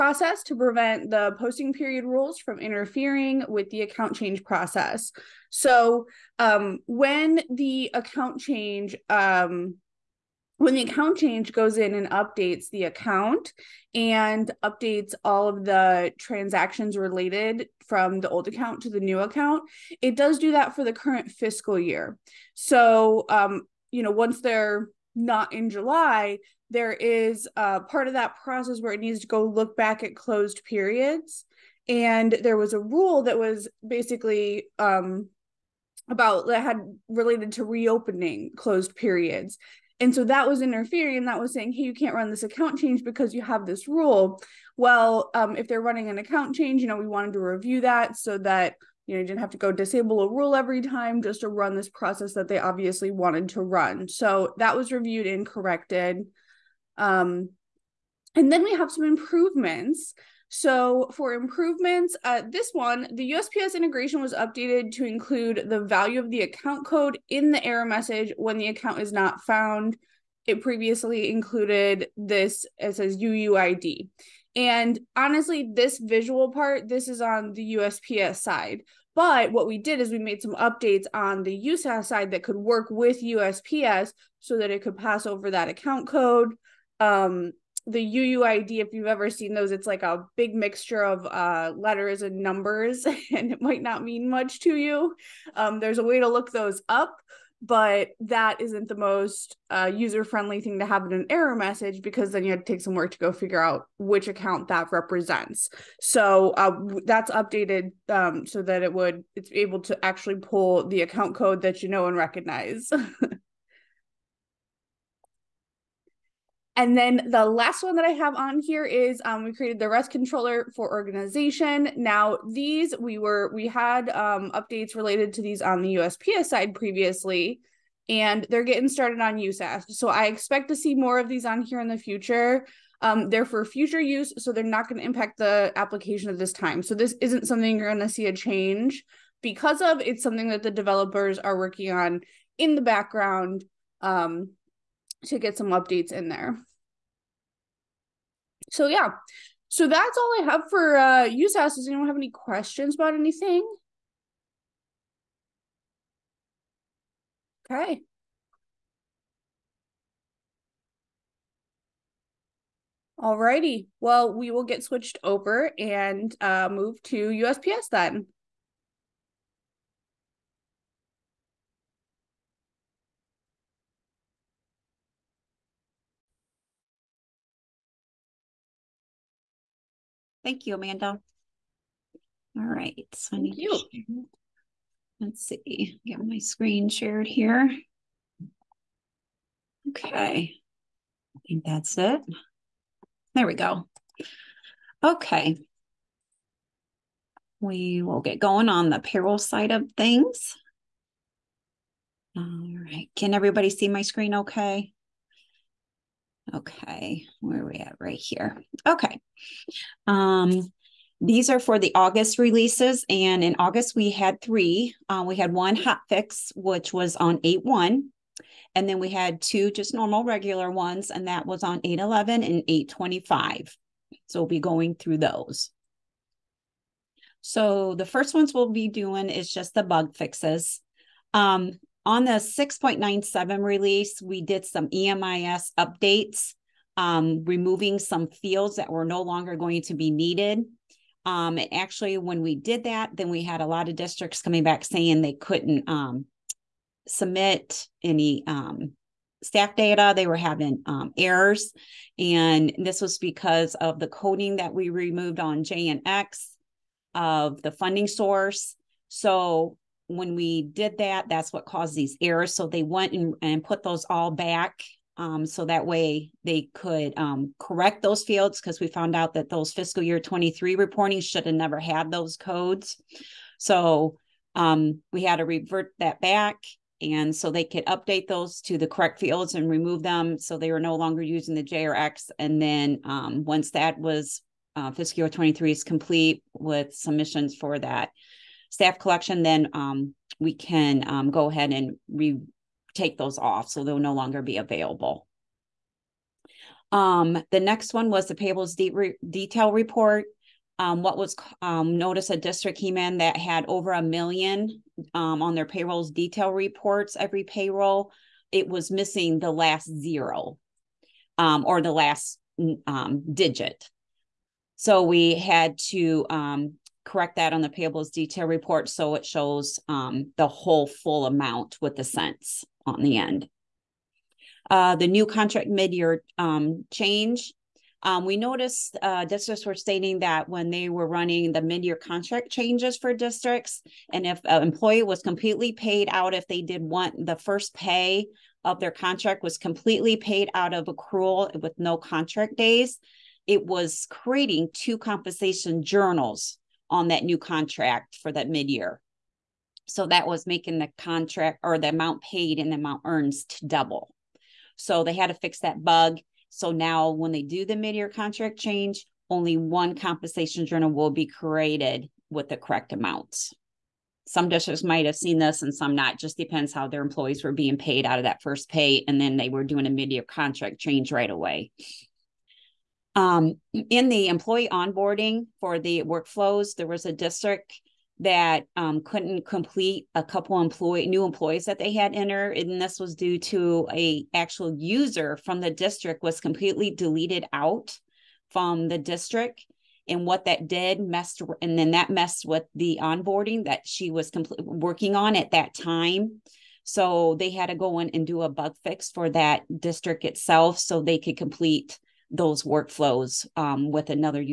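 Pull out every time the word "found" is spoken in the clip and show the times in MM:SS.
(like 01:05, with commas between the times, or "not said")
01:09, 04:28.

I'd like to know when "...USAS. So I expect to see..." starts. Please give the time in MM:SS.
02:09.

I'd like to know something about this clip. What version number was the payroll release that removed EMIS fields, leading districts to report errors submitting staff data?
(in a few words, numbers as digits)
6.97.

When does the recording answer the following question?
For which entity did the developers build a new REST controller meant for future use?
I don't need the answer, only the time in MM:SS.
02:00.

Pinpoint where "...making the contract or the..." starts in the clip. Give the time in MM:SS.
05:50.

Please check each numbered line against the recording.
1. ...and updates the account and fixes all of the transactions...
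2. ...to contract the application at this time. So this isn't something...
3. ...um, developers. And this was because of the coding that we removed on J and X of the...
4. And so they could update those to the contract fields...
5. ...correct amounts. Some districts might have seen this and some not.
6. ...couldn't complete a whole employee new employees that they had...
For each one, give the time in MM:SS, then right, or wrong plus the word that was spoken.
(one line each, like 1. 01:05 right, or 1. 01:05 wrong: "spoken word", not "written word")
1. 00:11 wrong: "updates", not "fixes"
2. 02:14 wrong: "impact", not "contract"
3. 04:10 wrong: "errors", not "developers"
4. 04:37 wrong: "correct", not "contract"
5. 06:02 right
6. 06:19 wrong: "couple", not "whole".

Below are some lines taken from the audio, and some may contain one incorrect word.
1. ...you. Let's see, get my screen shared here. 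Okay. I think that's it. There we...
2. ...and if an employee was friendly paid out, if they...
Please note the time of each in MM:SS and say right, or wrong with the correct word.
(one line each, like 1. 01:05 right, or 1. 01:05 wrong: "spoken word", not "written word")
1. 03:03 right
2. 05:34 wrong: "completely", not "friendly".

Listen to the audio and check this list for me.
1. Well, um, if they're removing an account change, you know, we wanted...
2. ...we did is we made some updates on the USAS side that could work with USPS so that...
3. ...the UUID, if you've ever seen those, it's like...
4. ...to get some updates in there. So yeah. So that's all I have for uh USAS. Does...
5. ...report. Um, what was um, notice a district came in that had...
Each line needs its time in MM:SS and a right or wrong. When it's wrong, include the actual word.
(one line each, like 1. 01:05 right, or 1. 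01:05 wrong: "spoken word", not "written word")
1. 00:44 wrong: "running", not "removing"
2. 01:19 right
3. 01:27 right
4. 02:25 right
5. 04:59 right.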